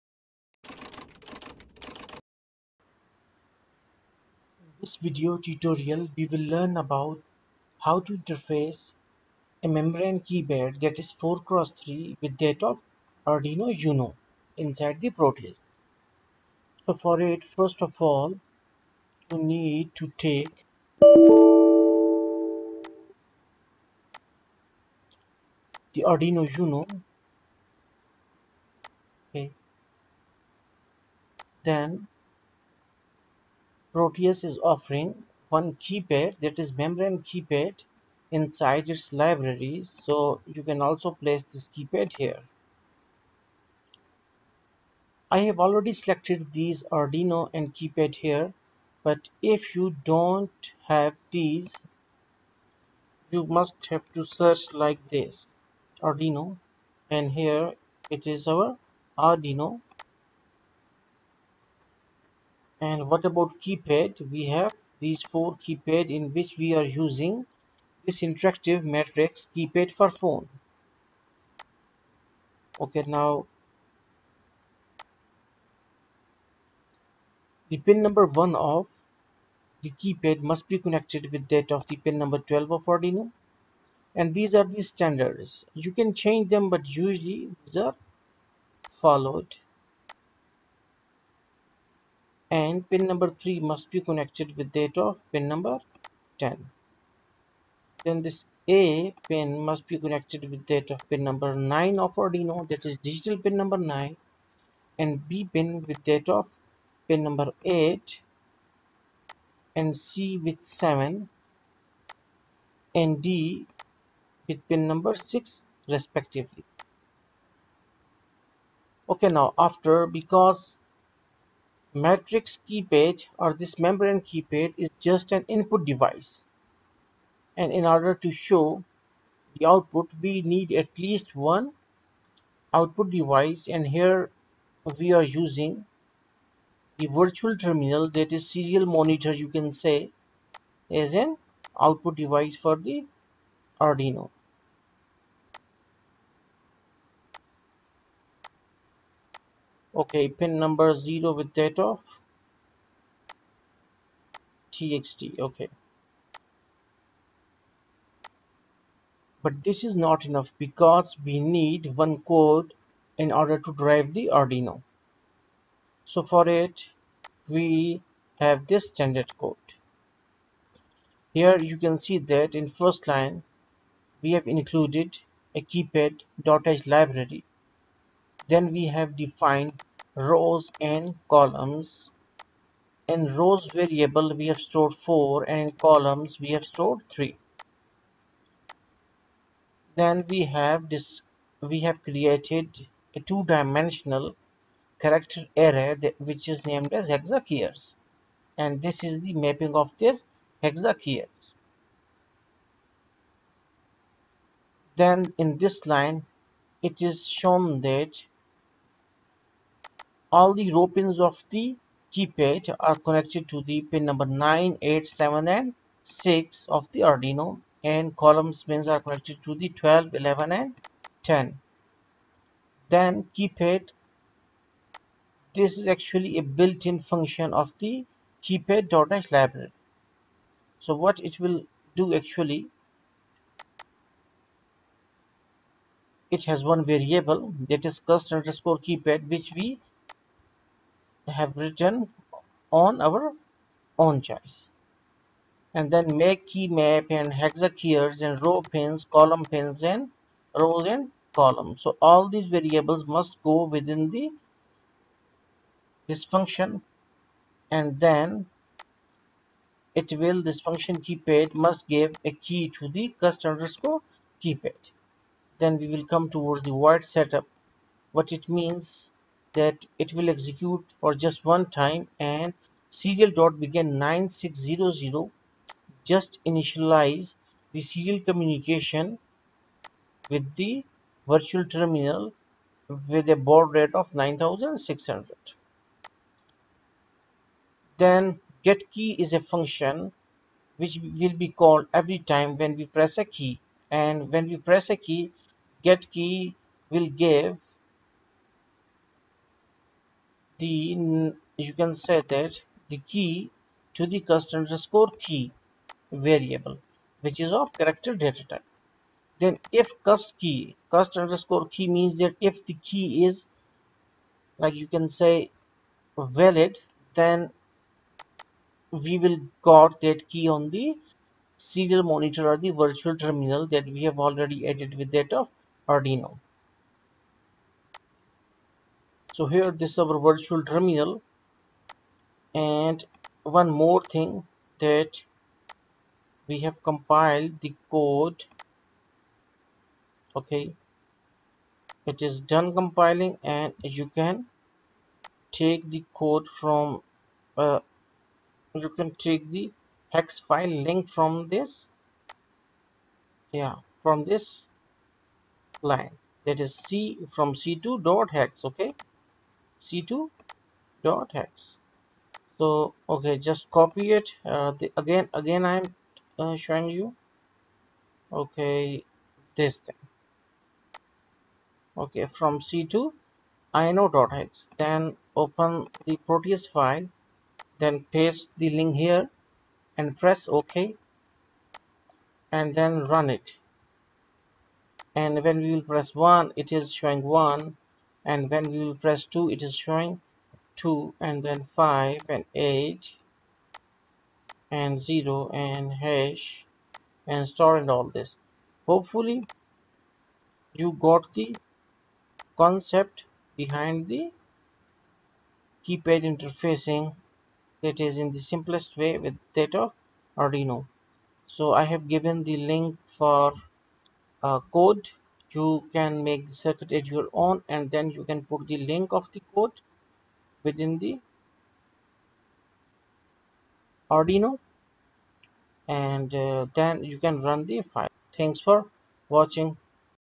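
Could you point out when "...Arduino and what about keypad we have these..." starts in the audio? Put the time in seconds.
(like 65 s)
59 s.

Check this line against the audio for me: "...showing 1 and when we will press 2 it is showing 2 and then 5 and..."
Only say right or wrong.
right.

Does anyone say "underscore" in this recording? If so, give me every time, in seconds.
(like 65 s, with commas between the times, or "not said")
238 s, 263 s, 304 s, 311 s.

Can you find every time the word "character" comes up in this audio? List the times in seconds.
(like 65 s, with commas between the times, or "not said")
195 s, 307 s.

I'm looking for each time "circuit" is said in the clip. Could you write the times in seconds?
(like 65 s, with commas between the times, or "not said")
416 s.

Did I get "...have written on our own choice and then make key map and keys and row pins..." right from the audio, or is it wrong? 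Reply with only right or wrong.
right.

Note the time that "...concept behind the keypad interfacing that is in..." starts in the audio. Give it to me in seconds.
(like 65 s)
402 s.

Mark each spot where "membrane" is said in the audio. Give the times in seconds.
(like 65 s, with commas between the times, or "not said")
9 s, 36 s, 123 s.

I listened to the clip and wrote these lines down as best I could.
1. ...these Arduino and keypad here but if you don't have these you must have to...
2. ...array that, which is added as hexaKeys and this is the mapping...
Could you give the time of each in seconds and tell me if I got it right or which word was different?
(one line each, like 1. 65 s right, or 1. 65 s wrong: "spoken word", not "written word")
1. 46 s right
2. 195 s wrong: "named", not "added".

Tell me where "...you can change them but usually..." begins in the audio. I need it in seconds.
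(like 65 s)
85 s.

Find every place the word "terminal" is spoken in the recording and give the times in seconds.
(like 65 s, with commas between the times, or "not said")
137 s, 281 s, 323 s, 330 s.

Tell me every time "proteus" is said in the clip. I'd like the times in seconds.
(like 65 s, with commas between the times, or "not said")
15 s, 33 s, 376 s.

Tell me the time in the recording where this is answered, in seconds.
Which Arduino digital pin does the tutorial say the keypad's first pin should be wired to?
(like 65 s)
82 s.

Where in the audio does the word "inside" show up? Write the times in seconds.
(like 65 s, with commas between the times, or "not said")
14 s, 38 s.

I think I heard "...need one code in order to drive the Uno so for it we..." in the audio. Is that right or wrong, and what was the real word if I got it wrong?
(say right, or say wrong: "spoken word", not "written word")
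wrong: "Arduino", not "Uno".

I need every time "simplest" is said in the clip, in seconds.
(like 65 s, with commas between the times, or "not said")
408 s.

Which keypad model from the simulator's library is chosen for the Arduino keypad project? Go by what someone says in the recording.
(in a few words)
interactive matrix keypad for phone.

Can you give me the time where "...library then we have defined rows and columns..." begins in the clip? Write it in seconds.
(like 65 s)
176 s.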